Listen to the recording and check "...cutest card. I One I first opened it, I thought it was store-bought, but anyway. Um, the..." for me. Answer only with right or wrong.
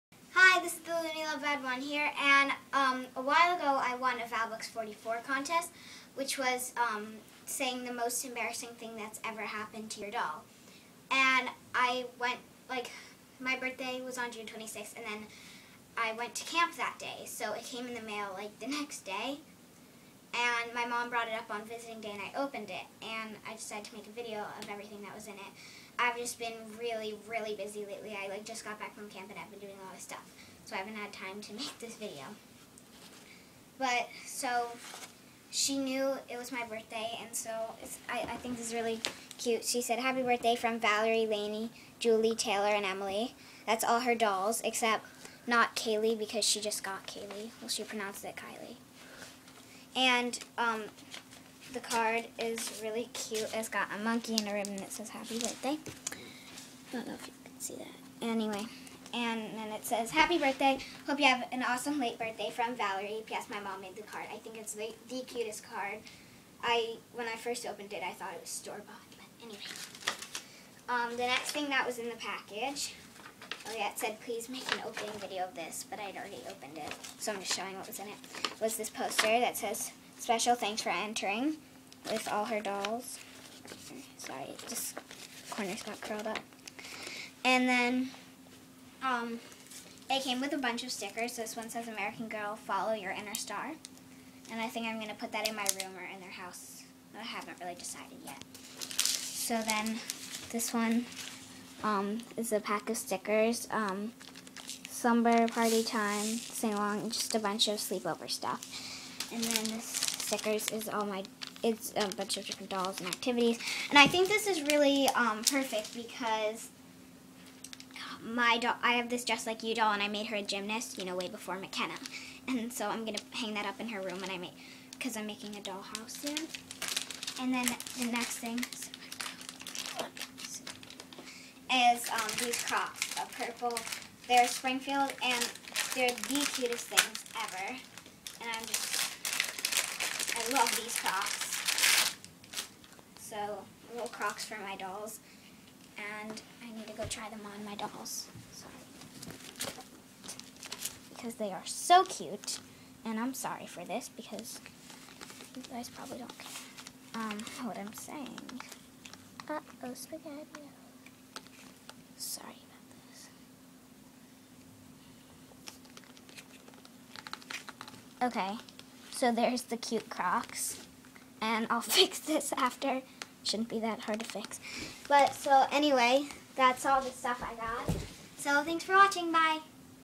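wrong.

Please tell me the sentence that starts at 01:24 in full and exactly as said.
Sorry, just corners got curled up.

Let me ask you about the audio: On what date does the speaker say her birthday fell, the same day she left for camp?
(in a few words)
June 26.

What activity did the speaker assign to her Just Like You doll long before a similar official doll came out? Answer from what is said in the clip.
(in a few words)
Gymnast.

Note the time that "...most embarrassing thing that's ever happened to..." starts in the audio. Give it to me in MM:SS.
00:07.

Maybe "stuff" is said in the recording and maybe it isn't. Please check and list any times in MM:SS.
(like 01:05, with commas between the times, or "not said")
00:29, 01:48, 02:57.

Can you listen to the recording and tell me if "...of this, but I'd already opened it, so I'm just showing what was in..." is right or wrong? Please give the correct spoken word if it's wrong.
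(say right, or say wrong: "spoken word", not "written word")
right.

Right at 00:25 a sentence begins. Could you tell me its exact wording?
I've just been really, really busy lately.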